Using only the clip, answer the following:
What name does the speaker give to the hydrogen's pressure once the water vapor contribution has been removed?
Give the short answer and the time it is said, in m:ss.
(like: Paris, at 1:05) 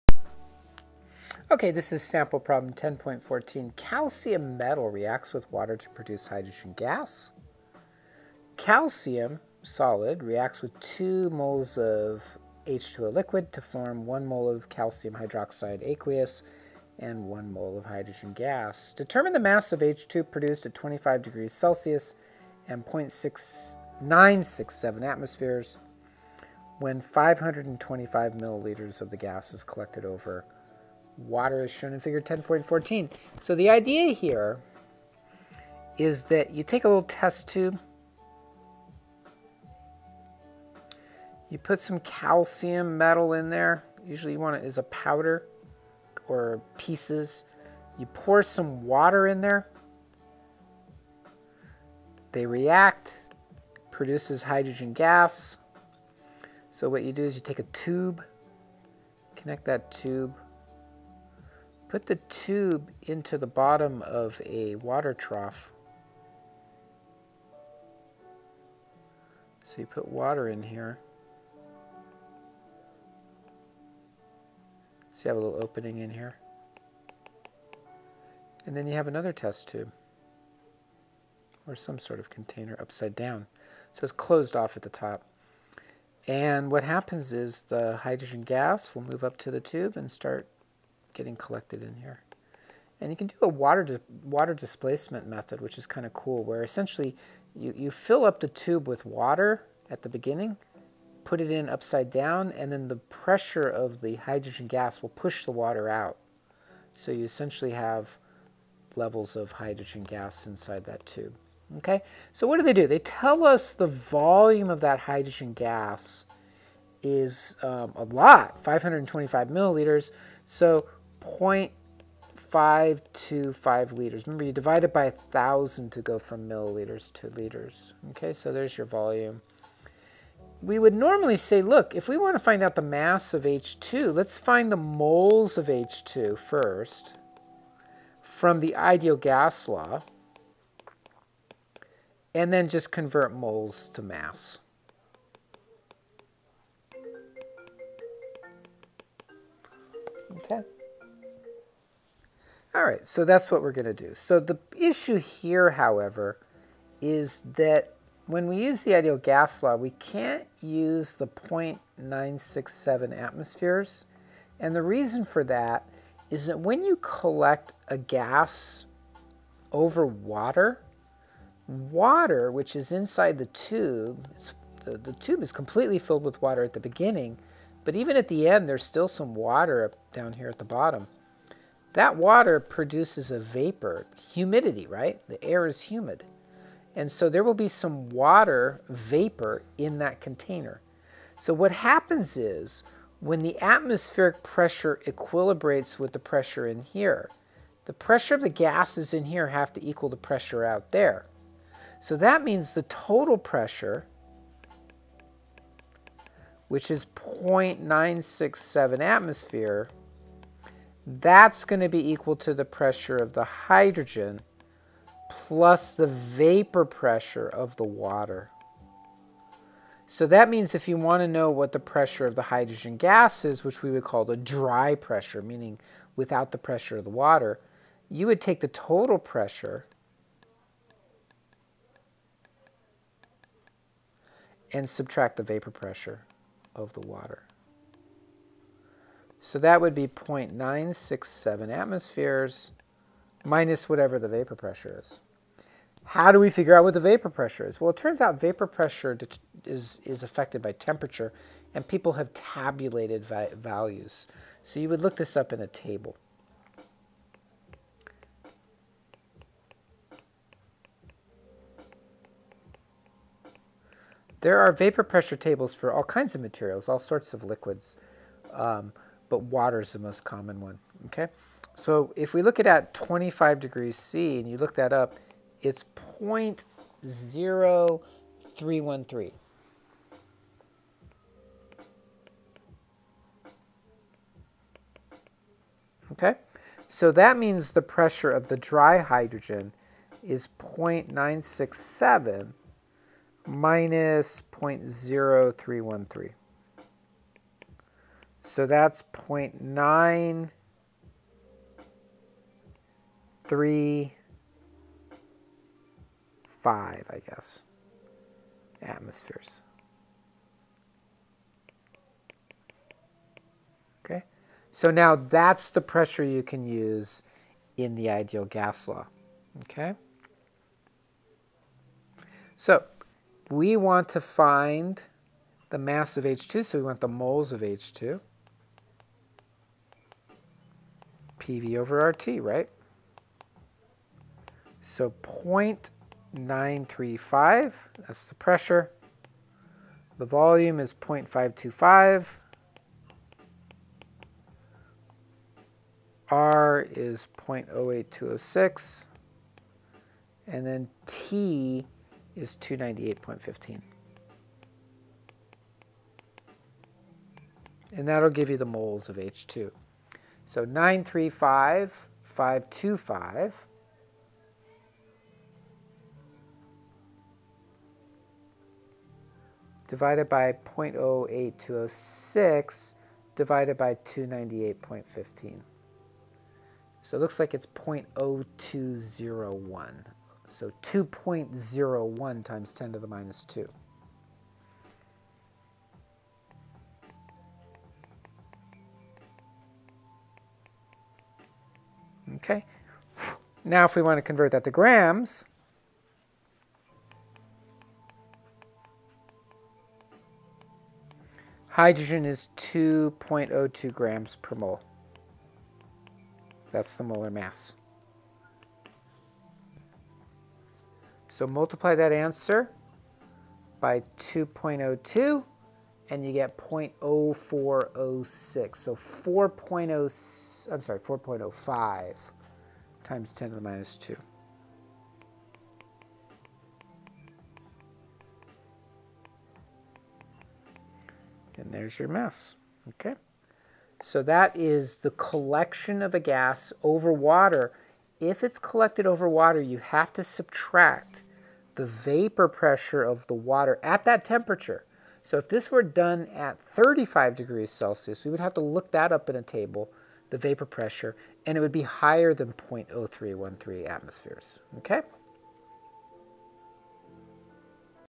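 dry pressure, at 3:44.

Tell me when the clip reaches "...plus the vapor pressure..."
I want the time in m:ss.
3:35.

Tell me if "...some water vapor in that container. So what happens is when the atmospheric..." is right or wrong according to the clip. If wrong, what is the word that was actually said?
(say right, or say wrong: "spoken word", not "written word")
right.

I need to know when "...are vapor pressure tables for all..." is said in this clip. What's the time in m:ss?
4:24.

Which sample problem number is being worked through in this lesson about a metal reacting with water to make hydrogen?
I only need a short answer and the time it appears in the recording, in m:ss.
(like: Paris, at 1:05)
10.14, at 0:02.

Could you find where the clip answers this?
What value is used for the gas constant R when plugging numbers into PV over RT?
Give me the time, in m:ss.
5:47.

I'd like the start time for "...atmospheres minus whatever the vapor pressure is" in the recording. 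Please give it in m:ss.
4:01.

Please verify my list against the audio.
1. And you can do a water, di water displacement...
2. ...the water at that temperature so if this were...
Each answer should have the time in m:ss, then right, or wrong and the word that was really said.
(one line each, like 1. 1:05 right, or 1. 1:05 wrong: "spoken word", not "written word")
1. 1:32 right
2. 7:23 right.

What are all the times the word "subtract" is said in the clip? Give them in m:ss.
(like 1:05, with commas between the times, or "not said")
3:54, 7:20.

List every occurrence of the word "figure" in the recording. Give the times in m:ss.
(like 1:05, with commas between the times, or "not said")
0:31, 4:06.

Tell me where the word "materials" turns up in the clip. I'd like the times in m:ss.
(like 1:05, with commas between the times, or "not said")
4:26.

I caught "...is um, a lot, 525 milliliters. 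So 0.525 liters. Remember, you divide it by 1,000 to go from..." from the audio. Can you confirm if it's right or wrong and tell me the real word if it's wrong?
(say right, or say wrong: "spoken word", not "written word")
right.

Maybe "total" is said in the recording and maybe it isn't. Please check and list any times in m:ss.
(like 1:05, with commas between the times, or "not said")
3:22, 3:48.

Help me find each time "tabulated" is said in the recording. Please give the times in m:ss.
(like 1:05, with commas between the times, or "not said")
4:12.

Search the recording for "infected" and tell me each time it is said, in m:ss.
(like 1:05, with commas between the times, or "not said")
not said.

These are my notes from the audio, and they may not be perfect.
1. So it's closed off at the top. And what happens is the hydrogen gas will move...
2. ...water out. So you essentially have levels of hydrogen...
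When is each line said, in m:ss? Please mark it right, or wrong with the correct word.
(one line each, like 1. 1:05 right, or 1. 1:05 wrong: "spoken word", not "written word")
1. 1:23 right
2. 1:45 right.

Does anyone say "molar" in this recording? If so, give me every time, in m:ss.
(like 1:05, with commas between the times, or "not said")
6:47.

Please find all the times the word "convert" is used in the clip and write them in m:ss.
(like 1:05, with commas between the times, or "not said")
2:22, 6:34.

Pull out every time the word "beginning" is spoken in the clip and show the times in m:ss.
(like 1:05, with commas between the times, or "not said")
1:40, 2:56.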